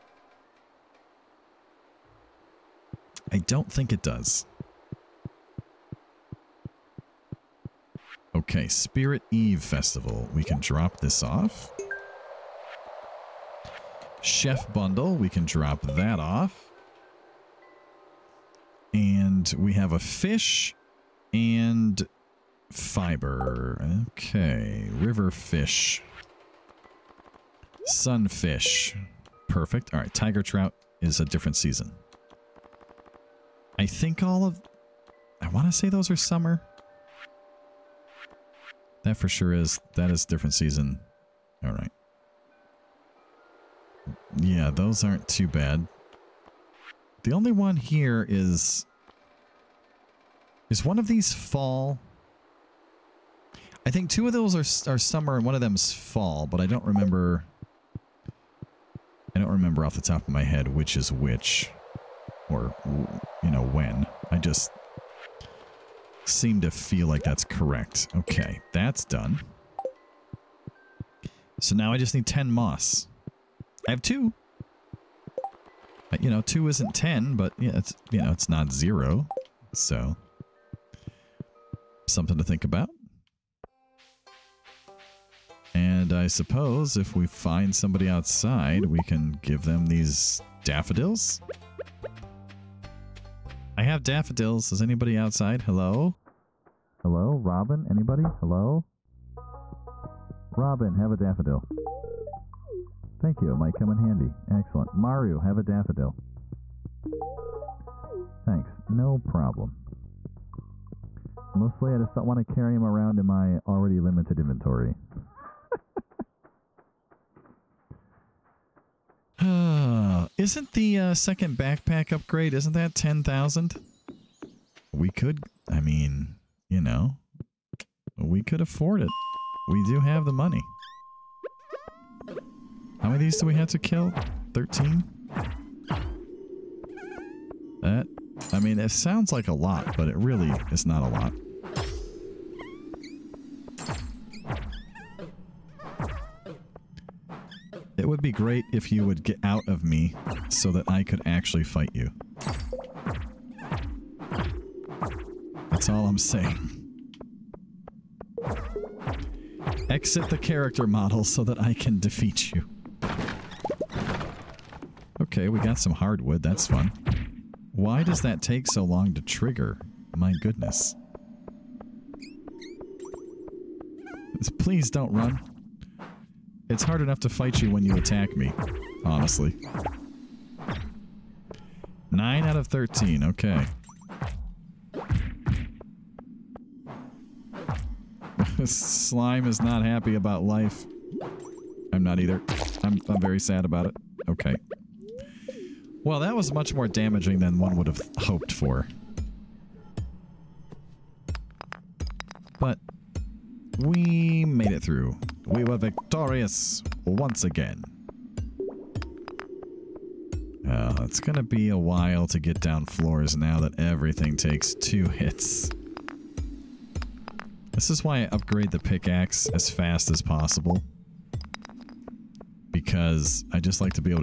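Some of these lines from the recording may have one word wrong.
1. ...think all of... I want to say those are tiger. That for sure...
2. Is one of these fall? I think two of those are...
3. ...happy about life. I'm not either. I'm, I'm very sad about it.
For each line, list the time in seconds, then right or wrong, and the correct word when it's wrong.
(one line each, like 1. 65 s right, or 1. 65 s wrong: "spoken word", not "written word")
1. 33 s wrong: "summer", not "tiger"
2. 50 s right
3. 189 s right.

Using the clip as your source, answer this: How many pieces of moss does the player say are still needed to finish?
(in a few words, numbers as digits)
10.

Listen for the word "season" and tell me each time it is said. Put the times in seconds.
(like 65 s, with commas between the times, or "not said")
31 s, 40 s.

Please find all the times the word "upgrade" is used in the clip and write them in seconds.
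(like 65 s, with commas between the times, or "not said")
122 s, 218 s.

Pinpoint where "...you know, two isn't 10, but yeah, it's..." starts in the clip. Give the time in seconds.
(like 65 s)
76 s.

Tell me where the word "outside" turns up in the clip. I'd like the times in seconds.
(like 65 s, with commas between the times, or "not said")
88 s, 95 s.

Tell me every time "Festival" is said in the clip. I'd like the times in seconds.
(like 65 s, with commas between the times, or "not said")
9 s.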